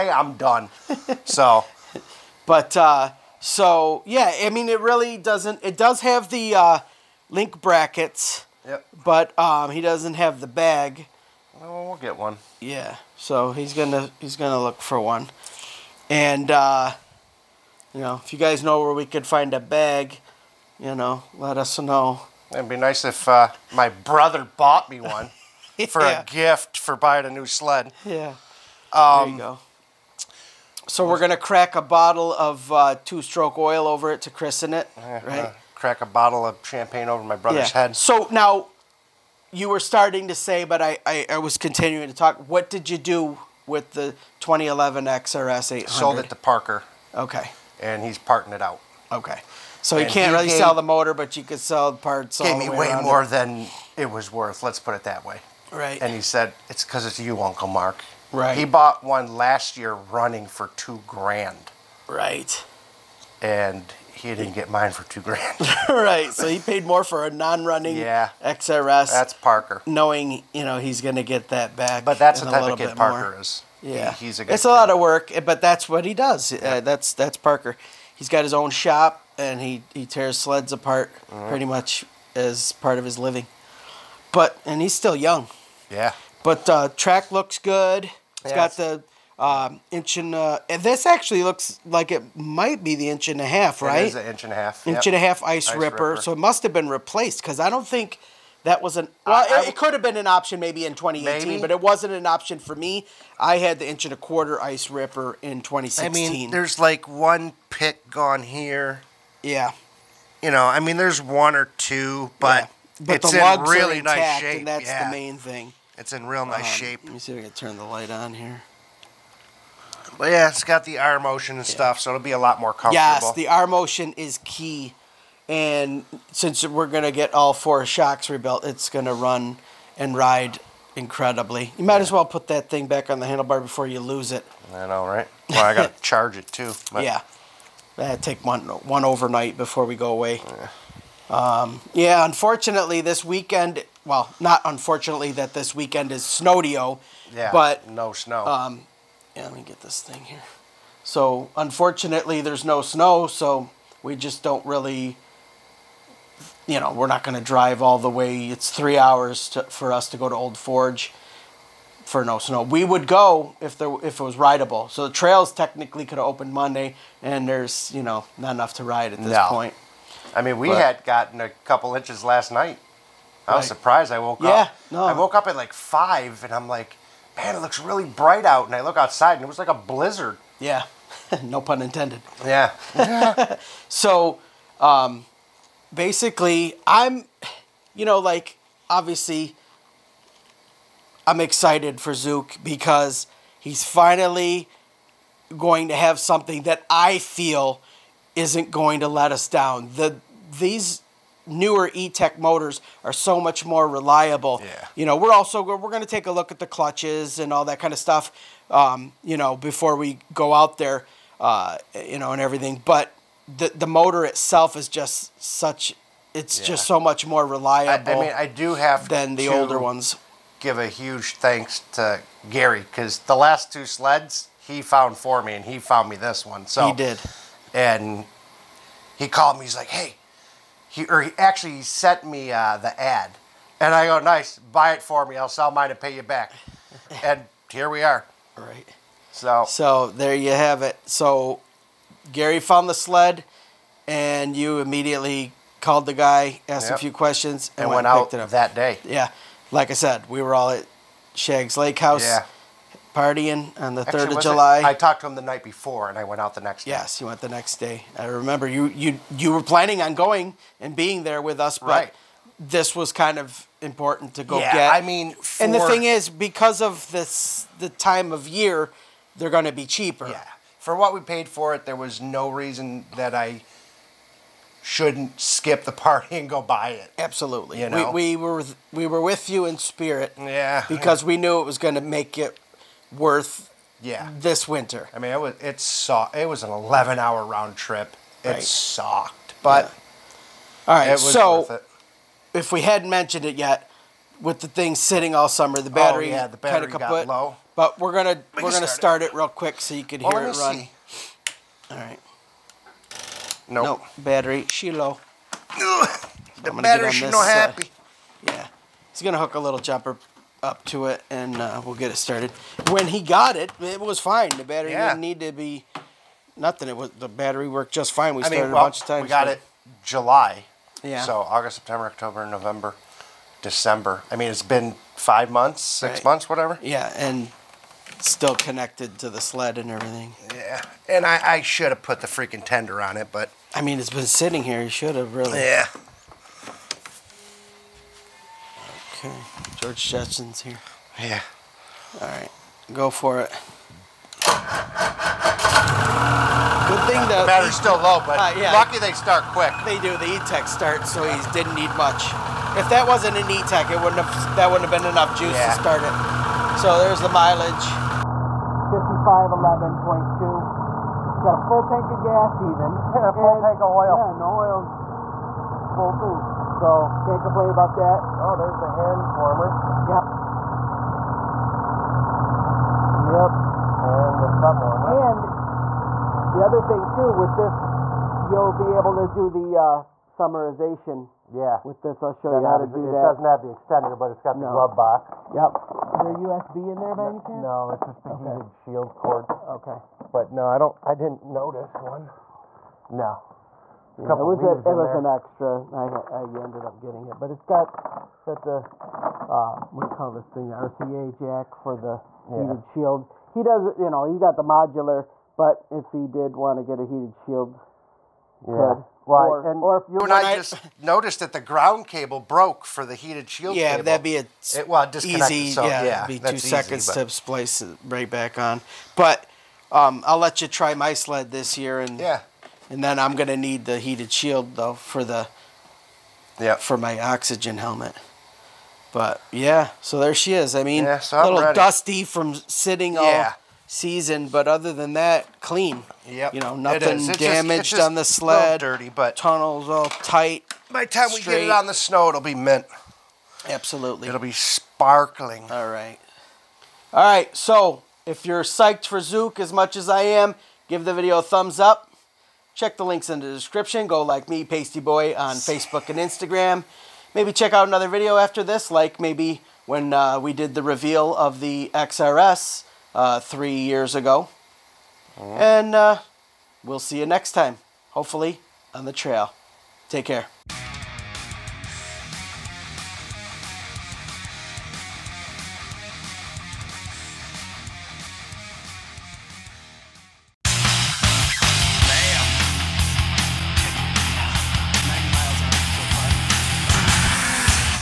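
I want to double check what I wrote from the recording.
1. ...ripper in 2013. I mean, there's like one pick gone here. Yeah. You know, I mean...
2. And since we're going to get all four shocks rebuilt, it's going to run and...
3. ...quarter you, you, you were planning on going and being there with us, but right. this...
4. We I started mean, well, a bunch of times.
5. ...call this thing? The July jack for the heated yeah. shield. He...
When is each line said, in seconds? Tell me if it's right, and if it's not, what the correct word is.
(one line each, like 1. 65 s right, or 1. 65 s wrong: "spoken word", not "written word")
1. 104 s wrong: "2016", not "2013"
2. 125 s right
3. 258 s wrong: "remember", not "quarter"
4. 318 s right
5. 400 s wrong: "RCA", not "July".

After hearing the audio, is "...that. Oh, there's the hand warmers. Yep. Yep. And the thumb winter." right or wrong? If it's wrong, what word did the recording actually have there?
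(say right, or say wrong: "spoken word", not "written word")
wrong: "warmer", not "winter".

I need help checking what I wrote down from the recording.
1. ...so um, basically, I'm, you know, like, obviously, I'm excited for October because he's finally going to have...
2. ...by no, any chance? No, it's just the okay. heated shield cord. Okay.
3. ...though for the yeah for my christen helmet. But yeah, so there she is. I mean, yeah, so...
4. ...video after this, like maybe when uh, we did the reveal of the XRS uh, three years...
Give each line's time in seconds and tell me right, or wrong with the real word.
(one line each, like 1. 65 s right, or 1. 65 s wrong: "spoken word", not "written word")
1. 183 s wrong: "Zuke", not "October"
2. 387 s right
3. 424 s wrong: "oxygen", not "christen"
4. 458 s right.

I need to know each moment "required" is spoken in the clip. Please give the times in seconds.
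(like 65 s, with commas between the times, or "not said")
not said.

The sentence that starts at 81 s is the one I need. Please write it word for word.
pretty much as part of his living.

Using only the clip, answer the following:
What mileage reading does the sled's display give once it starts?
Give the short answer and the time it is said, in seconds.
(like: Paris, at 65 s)
5511.2, at 358 s.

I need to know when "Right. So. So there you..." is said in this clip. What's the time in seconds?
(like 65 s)
238 s.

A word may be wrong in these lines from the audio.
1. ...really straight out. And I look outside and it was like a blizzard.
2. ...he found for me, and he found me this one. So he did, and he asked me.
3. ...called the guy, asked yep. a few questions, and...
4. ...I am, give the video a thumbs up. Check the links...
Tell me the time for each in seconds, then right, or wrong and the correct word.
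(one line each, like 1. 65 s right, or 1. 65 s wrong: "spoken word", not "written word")
1. 177 s wrong: "bright", not "straight"
2. 224 s wrong: "called", not "asked"
3. 245 s right
4. 450 s right.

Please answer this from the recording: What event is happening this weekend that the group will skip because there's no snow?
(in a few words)
Snodeo.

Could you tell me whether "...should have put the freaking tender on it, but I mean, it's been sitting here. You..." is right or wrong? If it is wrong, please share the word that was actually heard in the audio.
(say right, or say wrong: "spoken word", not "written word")
right.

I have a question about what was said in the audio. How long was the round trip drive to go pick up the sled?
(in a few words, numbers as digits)
11 hours.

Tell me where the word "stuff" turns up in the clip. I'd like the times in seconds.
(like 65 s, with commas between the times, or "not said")
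121 s, 207 s.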